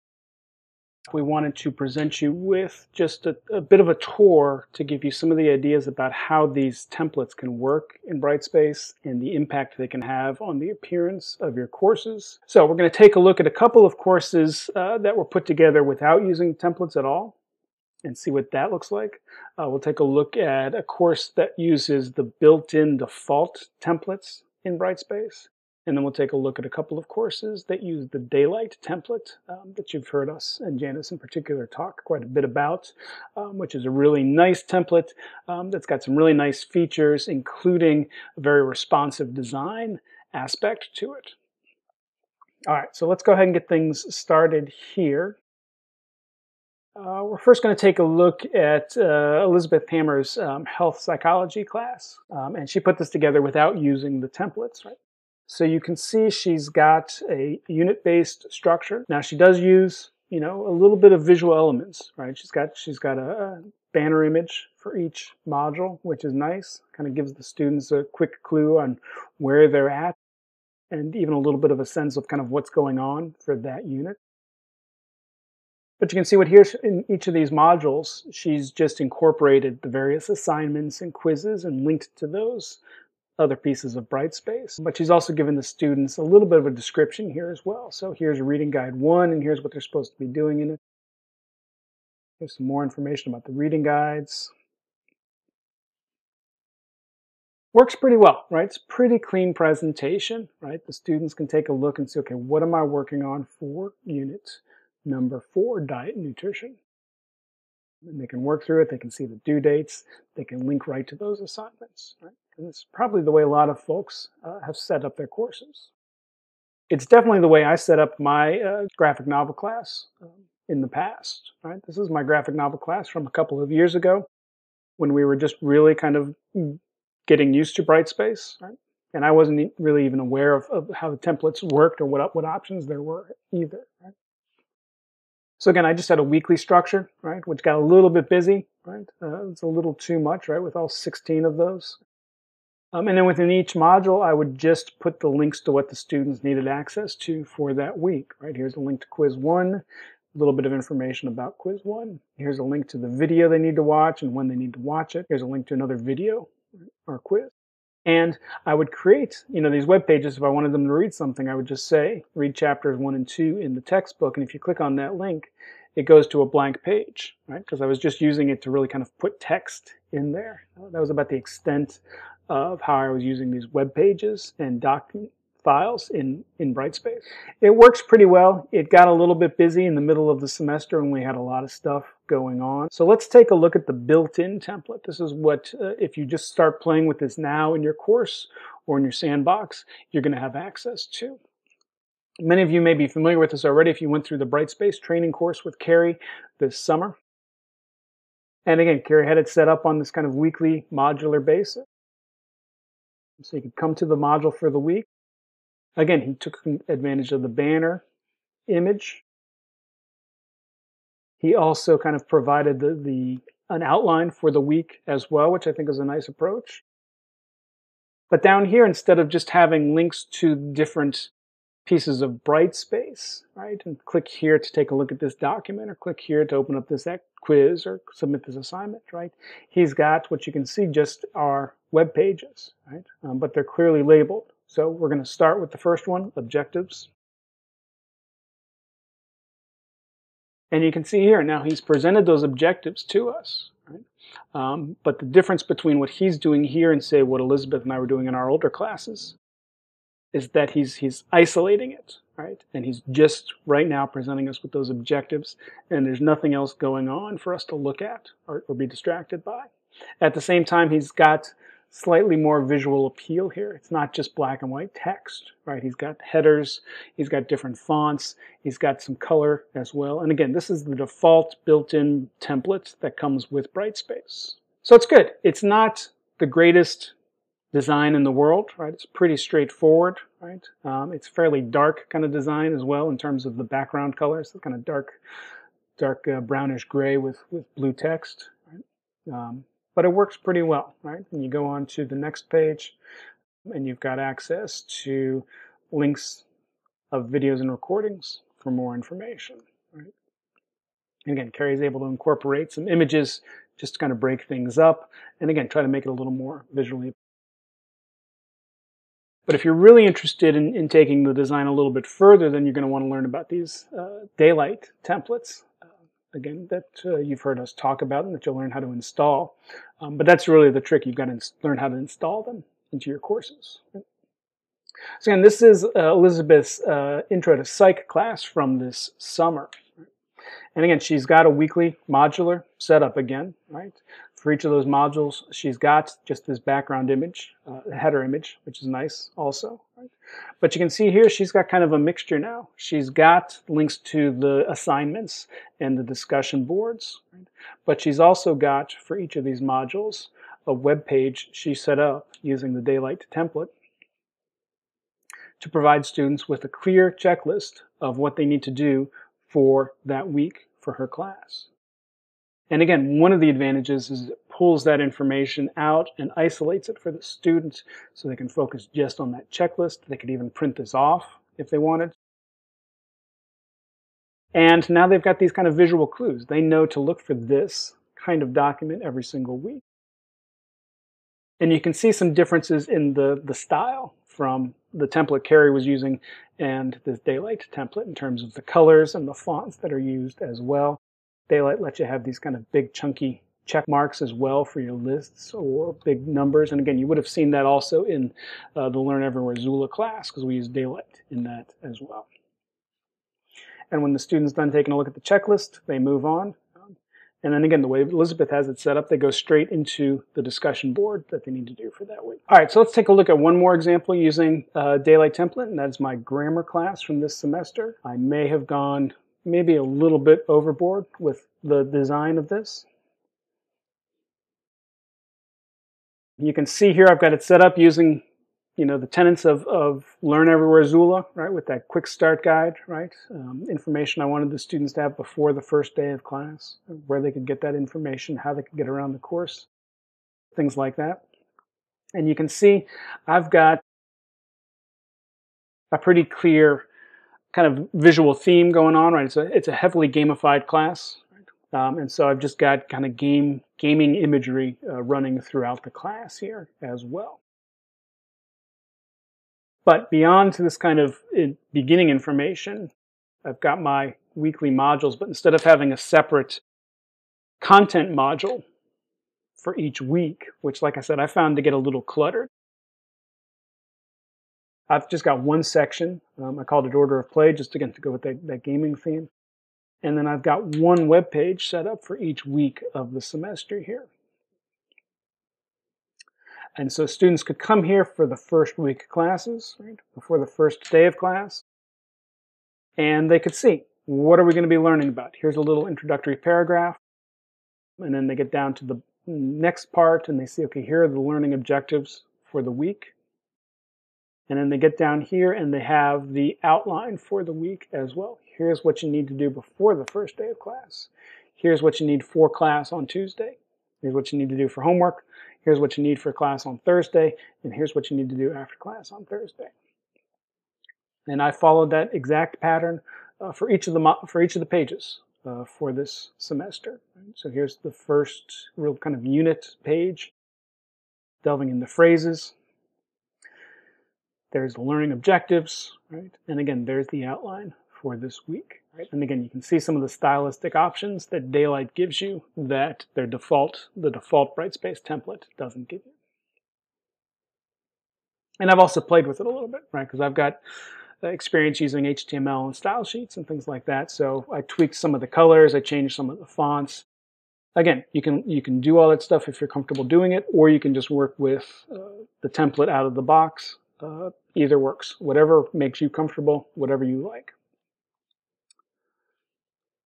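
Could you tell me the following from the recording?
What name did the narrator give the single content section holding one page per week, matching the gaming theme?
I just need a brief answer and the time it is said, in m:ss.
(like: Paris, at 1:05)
Order of Play, at 7:56.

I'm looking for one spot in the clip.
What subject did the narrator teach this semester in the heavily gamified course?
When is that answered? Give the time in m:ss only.
6:56.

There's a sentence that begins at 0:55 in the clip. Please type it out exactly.
So you can see she's got a unit-based structure.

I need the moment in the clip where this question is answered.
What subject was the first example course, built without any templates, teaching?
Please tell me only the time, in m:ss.
0:50.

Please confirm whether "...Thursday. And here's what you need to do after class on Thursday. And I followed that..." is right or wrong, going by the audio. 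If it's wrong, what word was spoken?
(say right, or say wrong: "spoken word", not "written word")
right.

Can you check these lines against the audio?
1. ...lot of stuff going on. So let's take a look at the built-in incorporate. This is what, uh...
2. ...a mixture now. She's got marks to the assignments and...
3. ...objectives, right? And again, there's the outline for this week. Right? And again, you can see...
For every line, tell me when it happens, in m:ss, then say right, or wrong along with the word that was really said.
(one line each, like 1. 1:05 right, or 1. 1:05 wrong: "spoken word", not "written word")
1. 3:01 wrong: "template", not "incorporate"
2. 5:41 wrong: "links", not "marks"
3. 8:55 right.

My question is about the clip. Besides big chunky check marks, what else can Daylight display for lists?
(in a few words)
Big numbers.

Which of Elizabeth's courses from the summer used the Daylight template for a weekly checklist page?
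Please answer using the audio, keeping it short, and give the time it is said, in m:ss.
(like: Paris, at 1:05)
Intro to Psych, at 5:27.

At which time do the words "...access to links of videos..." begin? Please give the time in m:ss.
4:54.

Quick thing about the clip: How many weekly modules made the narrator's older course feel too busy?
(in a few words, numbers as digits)
16.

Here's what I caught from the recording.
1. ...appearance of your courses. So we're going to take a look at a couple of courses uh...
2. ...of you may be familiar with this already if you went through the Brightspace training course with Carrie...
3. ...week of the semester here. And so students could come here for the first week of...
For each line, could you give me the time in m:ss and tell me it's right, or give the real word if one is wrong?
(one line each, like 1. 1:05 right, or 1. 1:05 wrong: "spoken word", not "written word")
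1. 0:10 right
2. 3:12 right
3. 8:02 right.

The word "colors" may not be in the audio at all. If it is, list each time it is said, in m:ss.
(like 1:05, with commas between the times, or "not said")
4:29, 4:44, 6:28, 9:15.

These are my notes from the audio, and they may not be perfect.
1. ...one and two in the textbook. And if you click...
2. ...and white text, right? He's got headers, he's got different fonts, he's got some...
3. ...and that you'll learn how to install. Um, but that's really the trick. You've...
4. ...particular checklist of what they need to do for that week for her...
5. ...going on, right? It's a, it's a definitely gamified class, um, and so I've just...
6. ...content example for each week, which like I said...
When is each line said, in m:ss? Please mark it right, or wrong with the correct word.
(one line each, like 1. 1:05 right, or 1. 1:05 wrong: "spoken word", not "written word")
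1. 2:42 right
2. 4:24 right
3. 5:18 right
4. 5:56 wrong: "clear", not "particular"
5. 7:28 wrong: "heavily", not "definitely"
6. 7:47 wrong: "module", not "example".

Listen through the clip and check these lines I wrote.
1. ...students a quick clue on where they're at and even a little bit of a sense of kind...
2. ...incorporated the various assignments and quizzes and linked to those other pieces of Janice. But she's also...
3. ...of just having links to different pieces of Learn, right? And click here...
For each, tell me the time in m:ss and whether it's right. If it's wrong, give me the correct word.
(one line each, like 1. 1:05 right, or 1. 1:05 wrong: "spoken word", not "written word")
1. 1:07 right
2. 1:19 wrong: "Brightspace", not "Janice"
3. 3:39 wrong: "Brightspace", not "Learn".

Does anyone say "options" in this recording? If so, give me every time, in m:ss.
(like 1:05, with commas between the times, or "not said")
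2:12, 9:00.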